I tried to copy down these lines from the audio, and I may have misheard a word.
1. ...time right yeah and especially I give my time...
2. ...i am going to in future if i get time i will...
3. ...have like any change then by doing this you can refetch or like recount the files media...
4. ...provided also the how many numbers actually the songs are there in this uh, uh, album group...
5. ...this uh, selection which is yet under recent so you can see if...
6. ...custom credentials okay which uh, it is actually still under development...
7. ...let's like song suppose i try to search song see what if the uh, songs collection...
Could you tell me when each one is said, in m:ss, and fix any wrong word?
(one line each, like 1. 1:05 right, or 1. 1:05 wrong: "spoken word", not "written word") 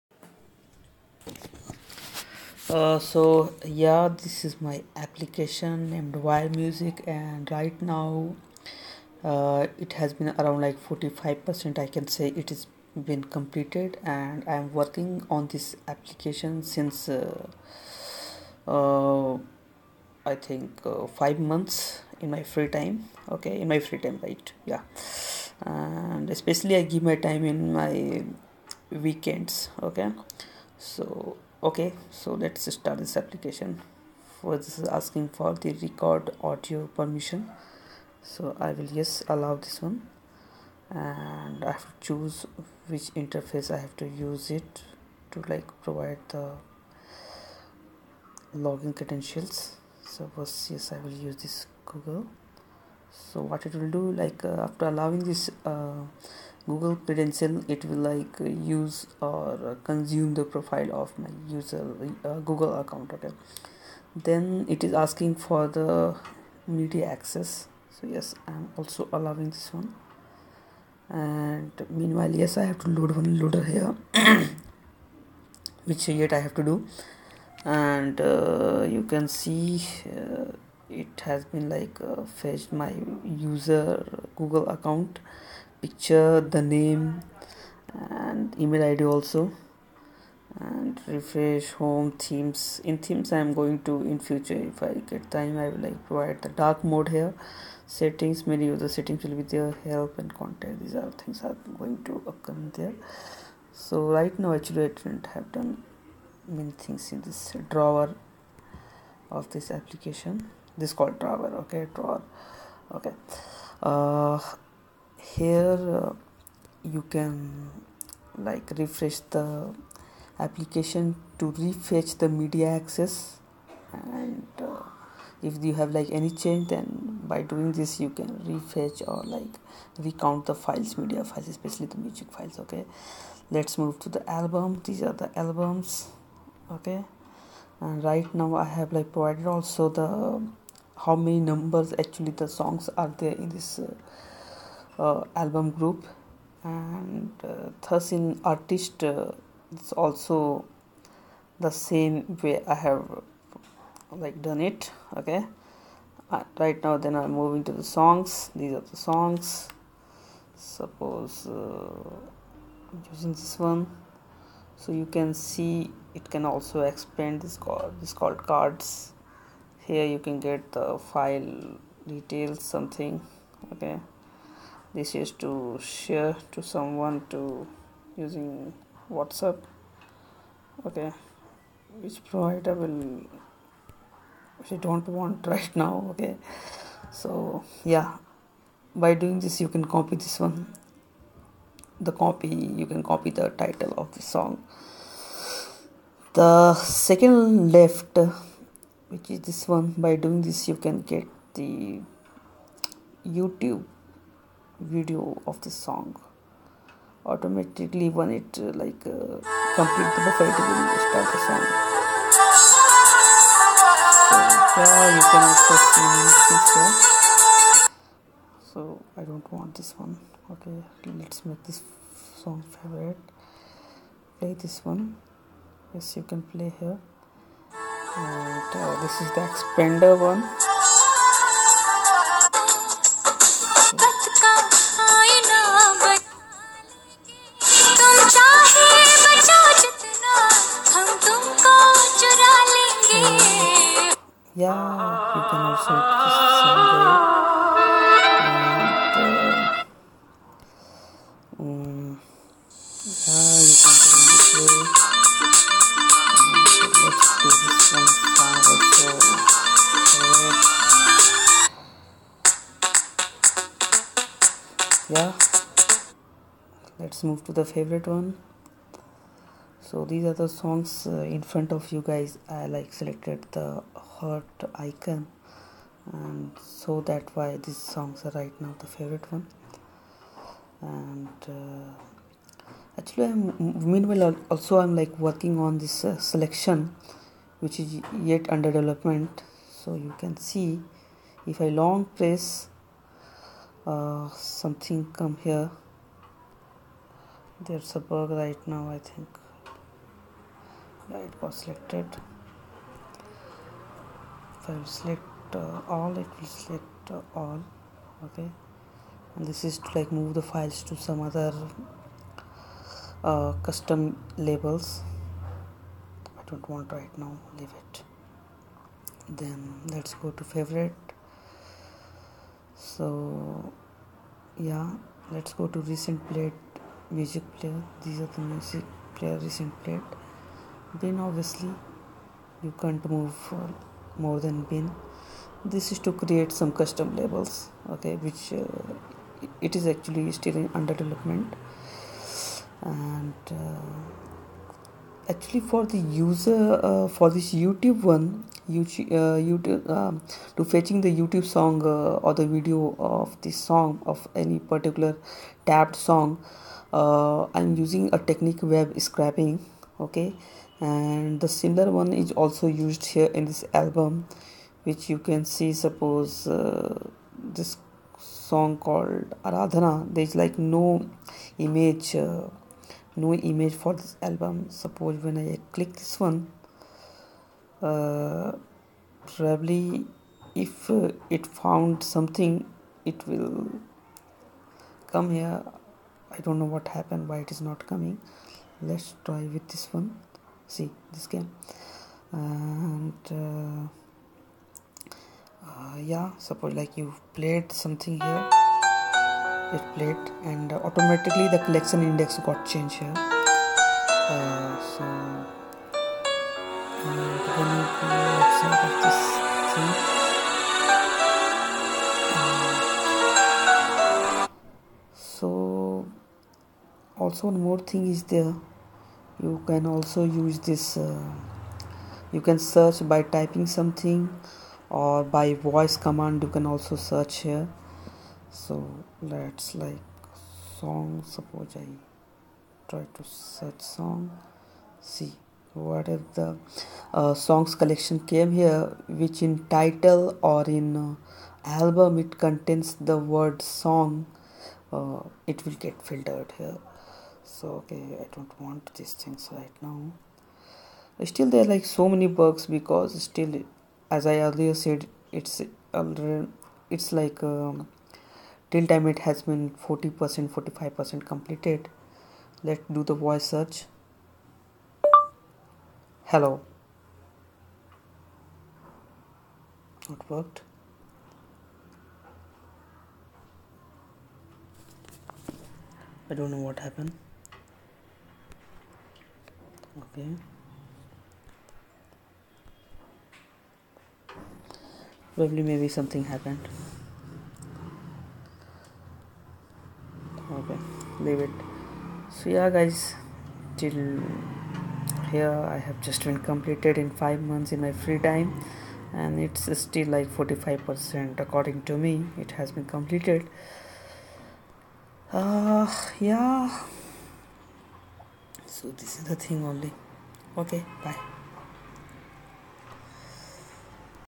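1. 0:23 right
2. 1:33 right
3. 2:05 right
4. 2:19 right
5. 4:45 wrong: "development", not "recent"
6. 5:36 wrong: "labels", not "credentials"
7. 7:09 right.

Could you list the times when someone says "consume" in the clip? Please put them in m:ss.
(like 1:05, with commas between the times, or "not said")
0:59.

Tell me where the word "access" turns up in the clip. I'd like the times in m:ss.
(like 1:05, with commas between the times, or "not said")
1:07, 2:02.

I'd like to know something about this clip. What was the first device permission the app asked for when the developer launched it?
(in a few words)
record audio.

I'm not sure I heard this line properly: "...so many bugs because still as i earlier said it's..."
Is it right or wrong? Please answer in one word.
right.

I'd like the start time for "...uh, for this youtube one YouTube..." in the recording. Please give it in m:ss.
5:46.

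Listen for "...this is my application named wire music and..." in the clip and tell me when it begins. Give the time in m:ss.
0:04.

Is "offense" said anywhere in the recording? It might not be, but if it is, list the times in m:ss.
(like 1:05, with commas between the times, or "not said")
not said.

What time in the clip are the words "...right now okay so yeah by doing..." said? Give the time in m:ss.
3:05.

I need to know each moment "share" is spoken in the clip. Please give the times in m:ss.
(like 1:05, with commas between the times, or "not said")
2:55.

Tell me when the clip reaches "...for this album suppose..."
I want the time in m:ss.
6:13.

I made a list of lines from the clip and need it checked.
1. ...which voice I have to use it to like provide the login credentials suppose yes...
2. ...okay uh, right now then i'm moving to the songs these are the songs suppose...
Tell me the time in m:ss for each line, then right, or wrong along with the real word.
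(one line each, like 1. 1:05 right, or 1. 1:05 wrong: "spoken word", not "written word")
1. 0:42 wrong: "interface", not "voice"
2. 2:35 right.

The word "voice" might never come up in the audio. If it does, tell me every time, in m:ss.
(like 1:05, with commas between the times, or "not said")
7:05, 7:43.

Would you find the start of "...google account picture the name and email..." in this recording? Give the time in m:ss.
1:24.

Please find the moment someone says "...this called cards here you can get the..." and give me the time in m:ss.
2:48.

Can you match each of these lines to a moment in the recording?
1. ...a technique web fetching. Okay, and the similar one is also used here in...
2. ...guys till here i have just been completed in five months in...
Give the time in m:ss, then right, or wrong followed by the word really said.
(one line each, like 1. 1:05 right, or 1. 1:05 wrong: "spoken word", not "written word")
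1. 5:58 wrong: "scraping", not "fetching"
2. 8:12 right.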